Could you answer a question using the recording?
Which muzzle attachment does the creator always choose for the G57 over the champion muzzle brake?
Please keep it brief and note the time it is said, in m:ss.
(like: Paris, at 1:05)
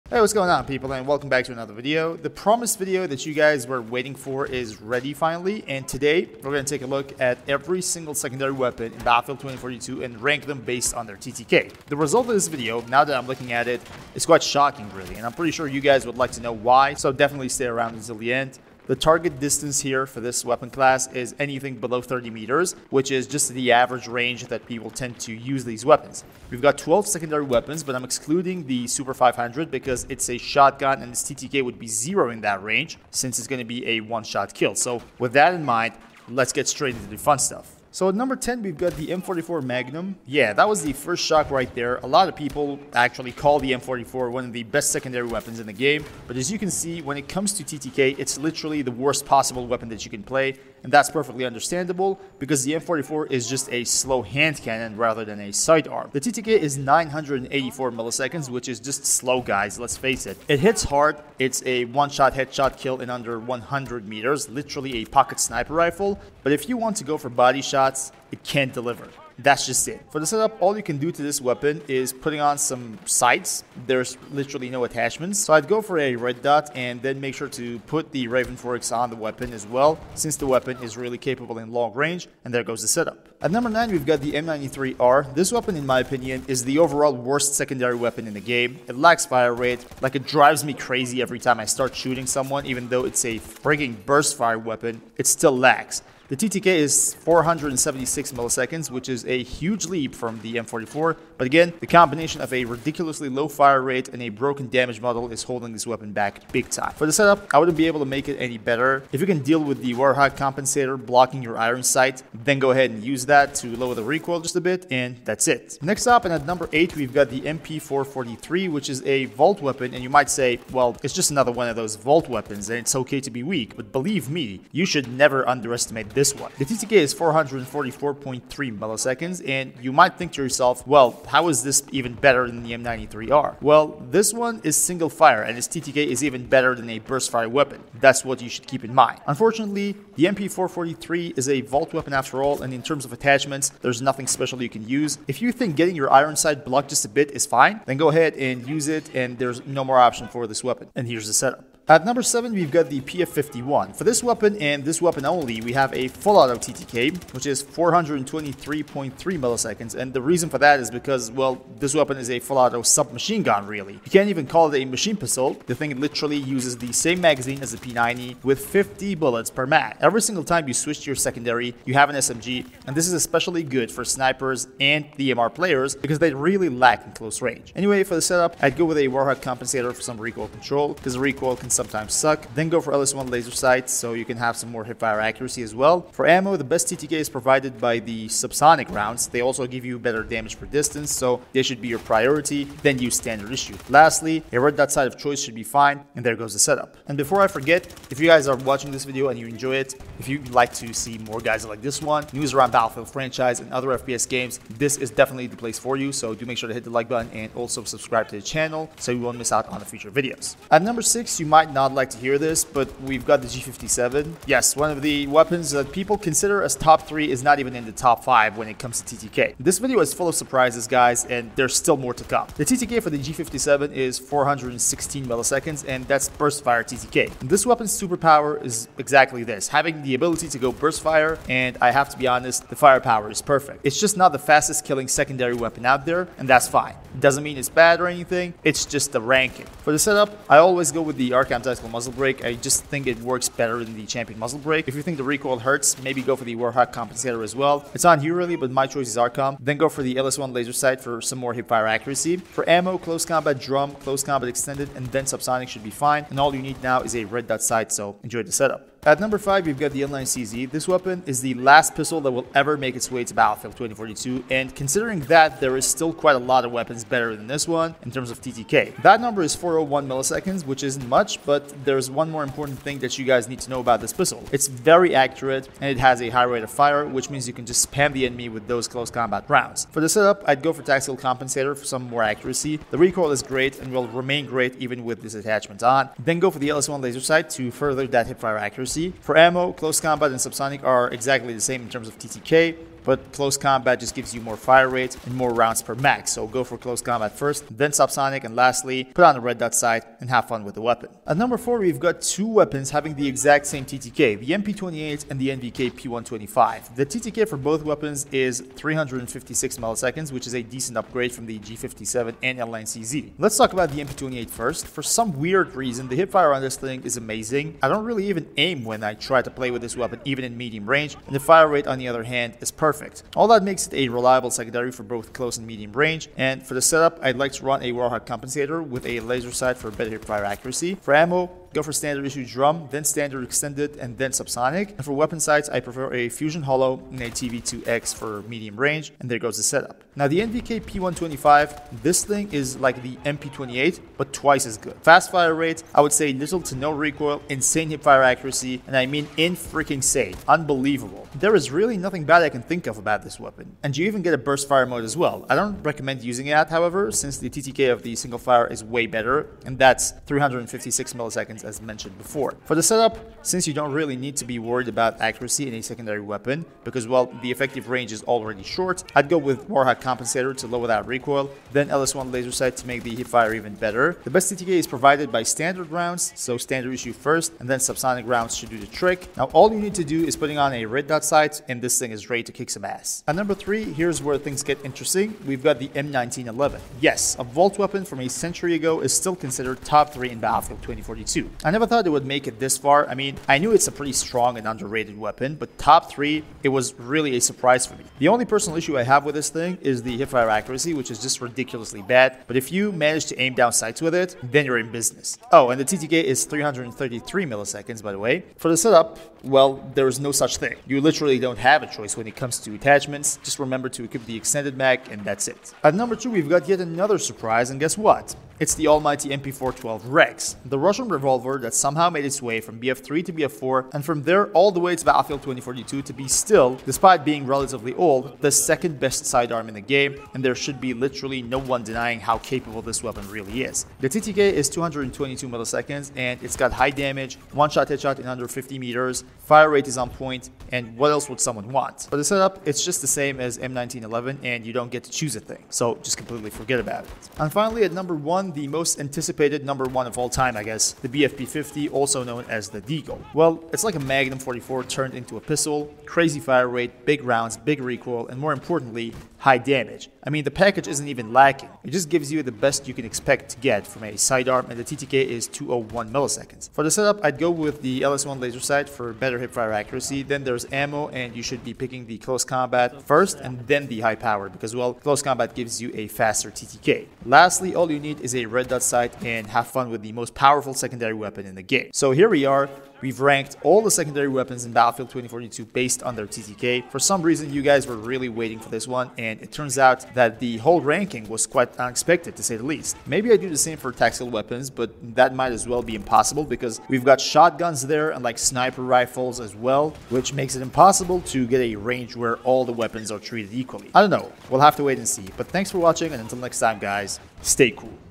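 RK anti muzzle brake, at 4:01.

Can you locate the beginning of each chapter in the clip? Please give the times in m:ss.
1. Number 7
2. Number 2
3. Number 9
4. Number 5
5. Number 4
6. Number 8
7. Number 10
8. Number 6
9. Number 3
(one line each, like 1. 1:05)
1. 2:31
2. 6:55
3. 1:23
4. 4:19
5. 5:01
6. 1:55
7. 0:38
8. 3:30
9. 6:23.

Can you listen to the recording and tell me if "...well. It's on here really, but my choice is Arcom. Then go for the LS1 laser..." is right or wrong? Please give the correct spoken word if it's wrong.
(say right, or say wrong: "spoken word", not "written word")
right.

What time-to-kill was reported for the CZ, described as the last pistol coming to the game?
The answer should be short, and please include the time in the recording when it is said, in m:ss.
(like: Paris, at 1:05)
401 milliseconds, at 4:29.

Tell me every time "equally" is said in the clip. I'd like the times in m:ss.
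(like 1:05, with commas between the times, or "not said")
8:23.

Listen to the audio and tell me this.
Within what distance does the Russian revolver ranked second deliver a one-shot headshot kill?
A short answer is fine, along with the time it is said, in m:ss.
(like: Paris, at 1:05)
50 meters, at 7:18.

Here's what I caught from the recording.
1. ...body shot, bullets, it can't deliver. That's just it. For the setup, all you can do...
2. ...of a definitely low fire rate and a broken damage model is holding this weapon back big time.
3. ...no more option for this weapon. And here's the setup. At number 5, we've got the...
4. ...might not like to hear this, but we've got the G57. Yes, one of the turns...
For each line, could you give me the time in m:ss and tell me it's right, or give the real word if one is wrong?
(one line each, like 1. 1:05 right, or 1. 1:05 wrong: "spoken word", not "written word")
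1. 1:07 wrong: "shots", not "bullets"
2. 1:42 wrong: "ridiculously", not "definitely"
3. 2:29 wrong: "7", not "5"
4. 3:31 wrong: "weapons", not "turns".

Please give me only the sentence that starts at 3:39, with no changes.
This video is full of surprises guys, and there's still more to come.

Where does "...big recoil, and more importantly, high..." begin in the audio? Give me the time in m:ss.
7:37.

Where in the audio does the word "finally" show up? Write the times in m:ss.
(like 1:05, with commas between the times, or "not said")
0:05, 7:27.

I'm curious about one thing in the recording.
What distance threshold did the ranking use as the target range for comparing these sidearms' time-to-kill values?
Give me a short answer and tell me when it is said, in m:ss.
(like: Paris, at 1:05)
30 meters, at 0:22.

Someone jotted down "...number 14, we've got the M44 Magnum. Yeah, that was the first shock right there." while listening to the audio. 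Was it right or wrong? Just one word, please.
wrong.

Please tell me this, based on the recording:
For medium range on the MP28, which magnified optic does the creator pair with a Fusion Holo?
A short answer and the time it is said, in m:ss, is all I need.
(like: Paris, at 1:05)
TV2X, at 5:37.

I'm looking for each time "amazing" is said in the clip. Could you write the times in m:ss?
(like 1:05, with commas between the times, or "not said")
5:17.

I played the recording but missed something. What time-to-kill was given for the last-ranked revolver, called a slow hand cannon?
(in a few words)
984 milliseconds.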